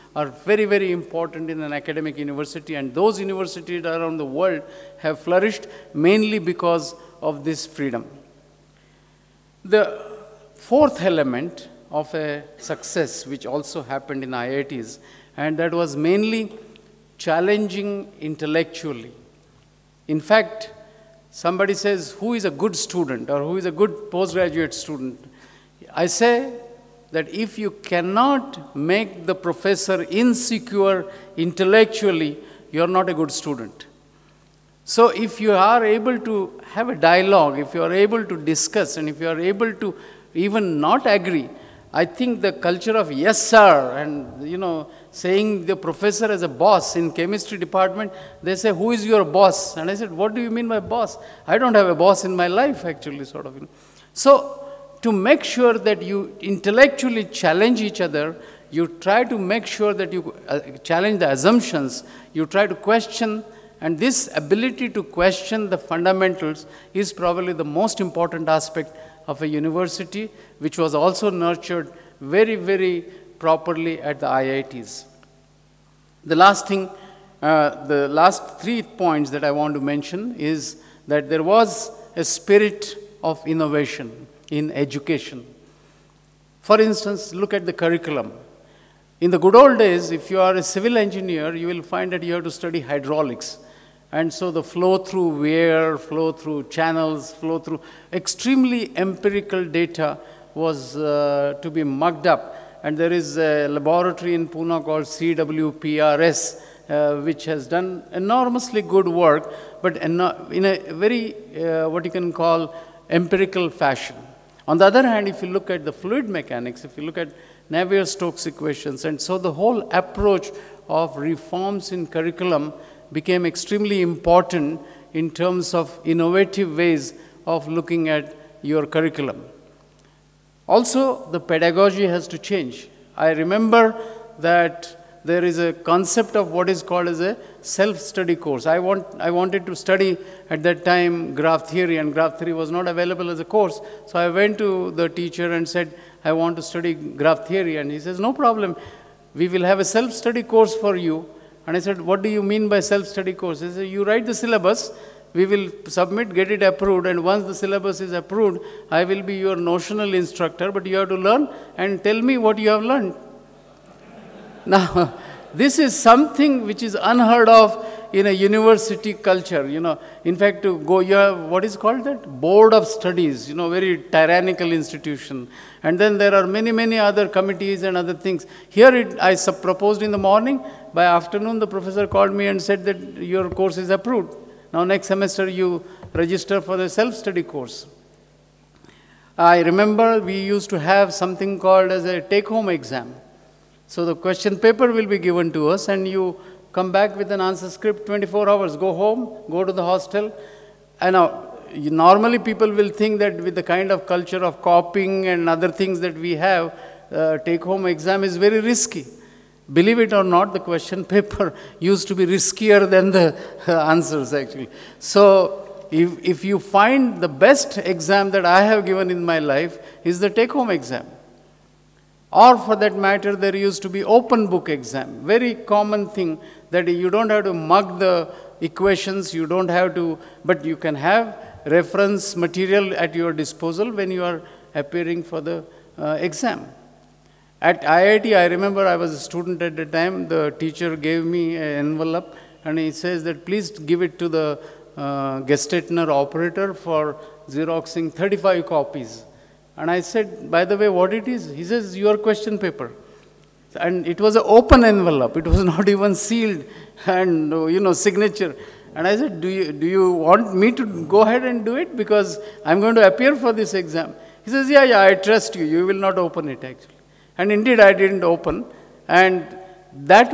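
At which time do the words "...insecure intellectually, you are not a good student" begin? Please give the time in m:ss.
0:30.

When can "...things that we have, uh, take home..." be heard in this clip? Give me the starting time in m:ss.
3:25.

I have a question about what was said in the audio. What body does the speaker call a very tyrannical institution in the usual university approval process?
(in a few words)
Board of Studies.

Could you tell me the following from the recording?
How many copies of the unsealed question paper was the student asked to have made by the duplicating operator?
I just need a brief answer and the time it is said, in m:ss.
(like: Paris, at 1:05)
35, at 4:08.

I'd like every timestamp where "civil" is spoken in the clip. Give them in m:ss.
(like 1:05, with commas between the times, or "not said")
1:30.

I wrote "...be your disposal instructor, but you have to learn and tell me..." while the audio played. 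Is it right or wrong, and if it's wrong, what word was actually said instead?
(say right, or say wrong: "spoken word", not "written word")
wrong: "notional", not "disposal".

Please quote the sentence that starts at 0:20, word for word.
In fact, somebody says who is a good student or who is a good postgraduate student.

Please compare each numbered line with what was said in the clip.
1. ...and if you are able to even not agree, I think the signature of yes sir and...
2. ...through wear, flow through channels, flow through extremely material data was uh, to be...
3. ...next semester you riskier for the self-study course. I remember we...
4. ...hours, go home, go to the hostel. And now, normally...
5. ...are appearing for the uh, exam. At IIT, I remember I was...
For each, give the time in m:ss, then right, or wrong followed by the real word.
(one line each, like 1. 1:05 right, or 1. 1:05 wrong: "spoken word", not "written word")
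1. 0:38 wrong: "culture", not "signature"
2. 1:34 wrong: "empirical", not "material"
3. 3:04 wrong: "register", not "riskier"
4. 3:18 right
5. 3:54 right.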